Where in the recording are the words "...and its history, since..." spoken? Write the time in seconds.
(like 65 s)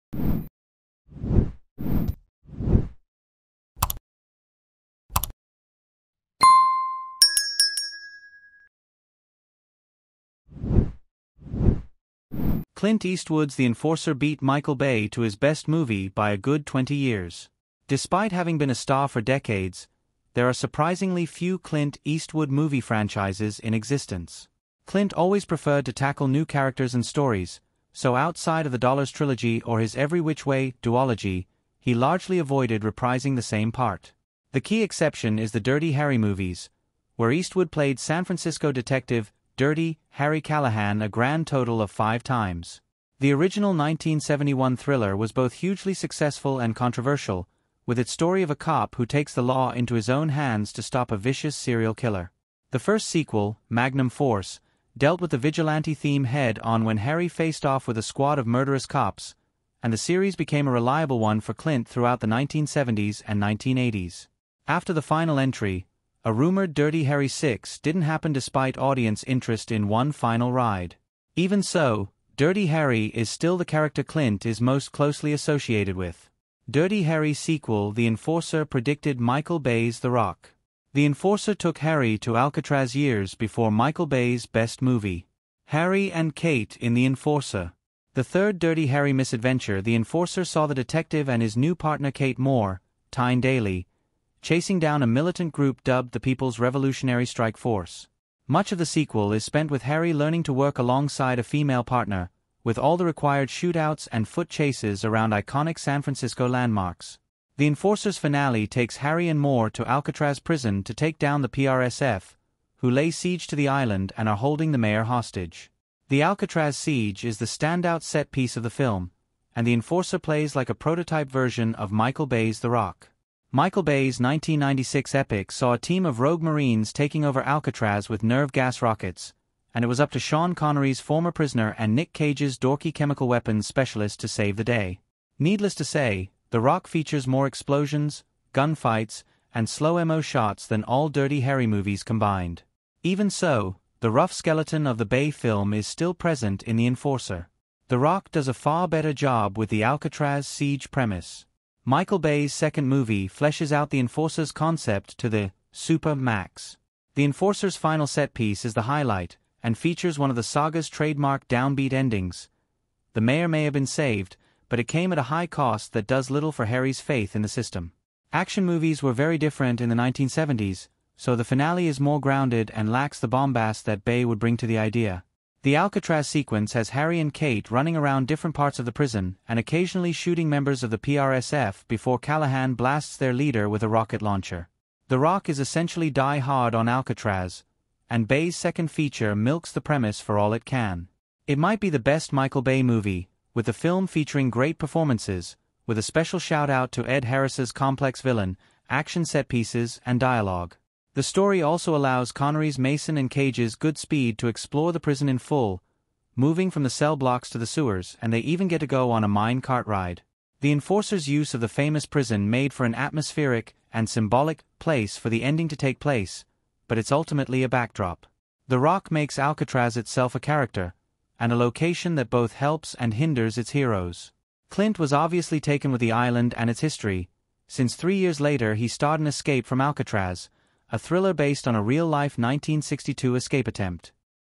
226 s.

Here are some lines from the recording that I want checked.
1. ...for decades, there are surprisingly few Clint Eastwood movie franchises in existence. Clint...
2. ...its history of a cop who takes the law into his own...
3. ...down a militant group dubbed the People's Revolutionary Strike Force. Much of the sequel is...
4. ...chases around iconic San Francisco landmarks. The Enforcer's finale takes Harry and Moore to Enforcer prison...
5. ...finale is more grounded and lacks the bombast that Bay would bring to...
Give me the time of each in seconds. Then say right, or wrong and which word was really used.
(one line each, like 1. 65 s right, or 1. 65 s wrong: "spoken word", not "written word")
1. 19 s right
2. 47 s wrong: "story", not "history"
3. 94 s right
4. 104 s wrong: "Alcatraz", not "Enforcer"
5. 171 s right.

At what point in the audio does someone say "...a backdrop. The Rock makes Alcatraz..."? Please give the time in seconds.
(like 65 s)
217 s.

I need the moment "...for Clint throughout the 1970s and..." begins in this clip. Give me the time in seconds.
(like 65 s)
61 s.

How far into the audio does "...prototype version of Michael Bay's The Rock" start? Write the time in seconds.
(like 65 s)
120 s.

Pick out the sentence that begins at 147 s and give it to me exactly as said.
The Rock does a far better job with the Alcatraz siege premise.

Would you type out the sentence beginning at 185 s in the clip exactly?
The Rock is essentially Die Hard on Alcatraz, and Bay's second feature milks the premise for all it can.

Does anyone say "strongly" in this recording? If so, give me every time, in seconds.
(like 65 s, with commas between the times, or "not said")
not said.